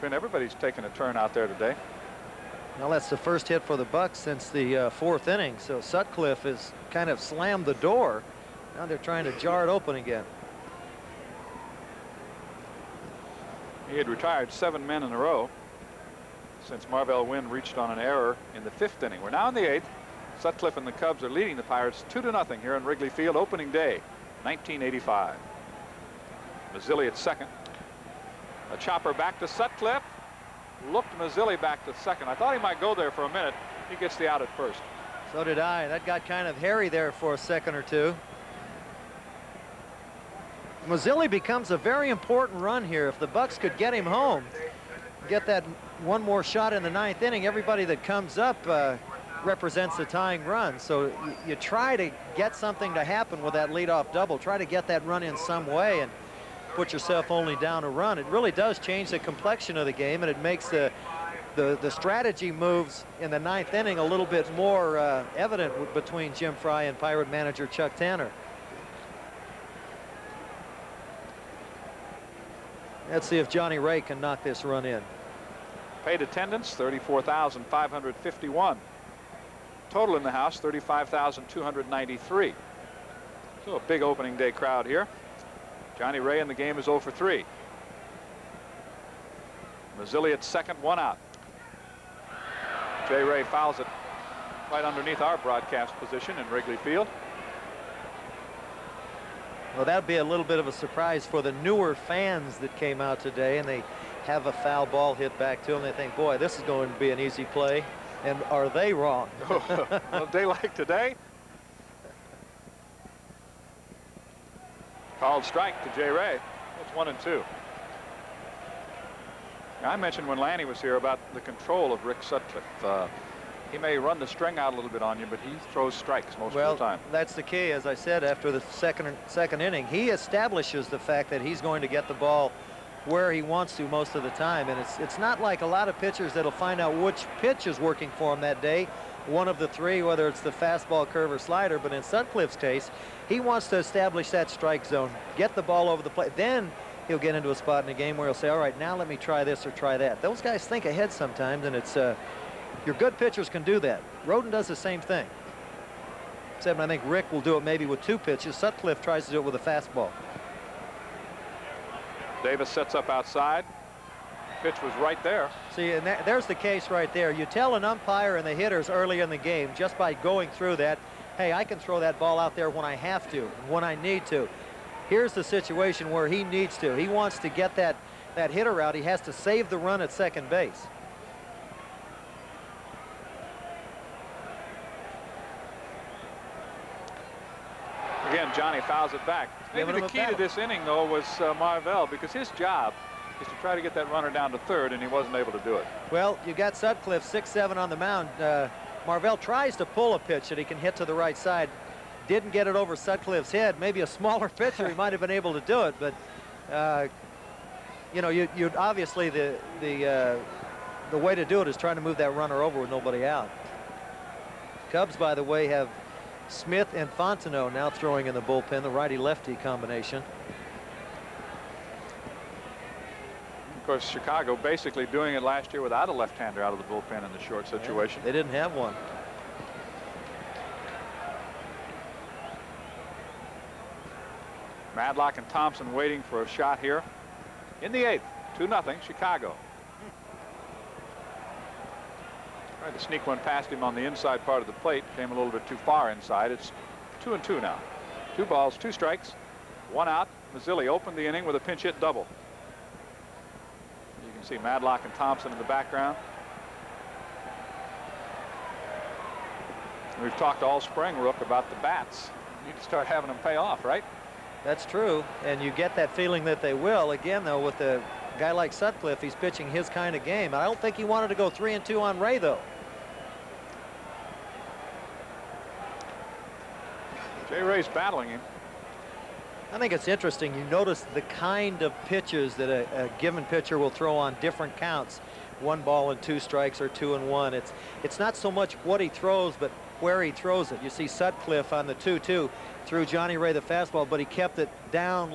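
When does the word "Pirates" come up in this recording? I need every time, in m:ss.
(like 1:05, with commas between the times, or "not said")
0:21, 1:06.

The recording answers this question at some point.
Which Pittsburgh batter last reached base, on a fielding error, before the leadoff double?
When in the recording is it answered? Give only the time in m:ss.
0:16.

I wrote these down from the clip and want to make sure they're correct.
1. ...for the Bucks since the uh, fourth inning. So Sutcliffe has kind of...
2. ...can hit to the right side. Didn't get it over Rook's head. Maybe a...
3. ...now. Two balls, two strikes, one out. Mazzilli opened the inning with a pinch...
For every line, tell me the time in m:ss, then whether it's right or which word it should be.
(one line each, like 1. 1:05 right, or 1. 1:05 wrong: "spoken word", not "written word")
1. 0:03 right
2. 3:20 wrong: "Sutcliffe", not "Rook"
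3. 4:07 right.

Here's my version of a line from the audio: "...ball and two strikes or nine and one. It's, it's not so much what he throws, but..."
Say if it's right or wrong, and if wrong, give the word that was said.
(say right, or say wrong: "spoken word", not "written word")
wrong: "two", not "nine".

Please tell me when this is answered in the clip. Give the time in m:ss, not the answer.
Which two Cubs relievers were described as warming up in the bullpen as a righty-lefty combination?
3:36.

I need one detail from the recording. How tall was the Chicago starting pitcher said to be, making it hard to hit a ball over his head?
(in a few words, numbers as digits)
6-7.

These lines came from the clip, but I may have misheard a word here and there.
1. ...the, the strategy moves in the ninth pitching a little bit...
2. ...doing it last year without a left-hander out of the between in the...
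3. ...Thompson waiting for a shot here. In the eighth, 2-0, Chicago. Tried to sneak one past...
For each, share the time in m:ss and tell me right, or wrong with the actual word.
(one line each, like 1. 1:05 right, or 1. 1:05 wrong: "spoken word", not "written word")
1. 1:01 wrong: "inning", not "pitching"
2. 3:45 wrong: "bullpen", not "between"
3. 3:55 right.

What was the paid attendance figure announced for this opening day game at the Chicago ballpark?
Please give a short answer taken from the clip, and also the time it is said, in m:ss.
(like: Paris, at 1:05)
34,551, at 1:16.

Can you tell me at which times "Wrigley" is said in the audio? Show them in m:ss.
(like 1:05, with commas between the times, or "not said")
0:22, 1:36.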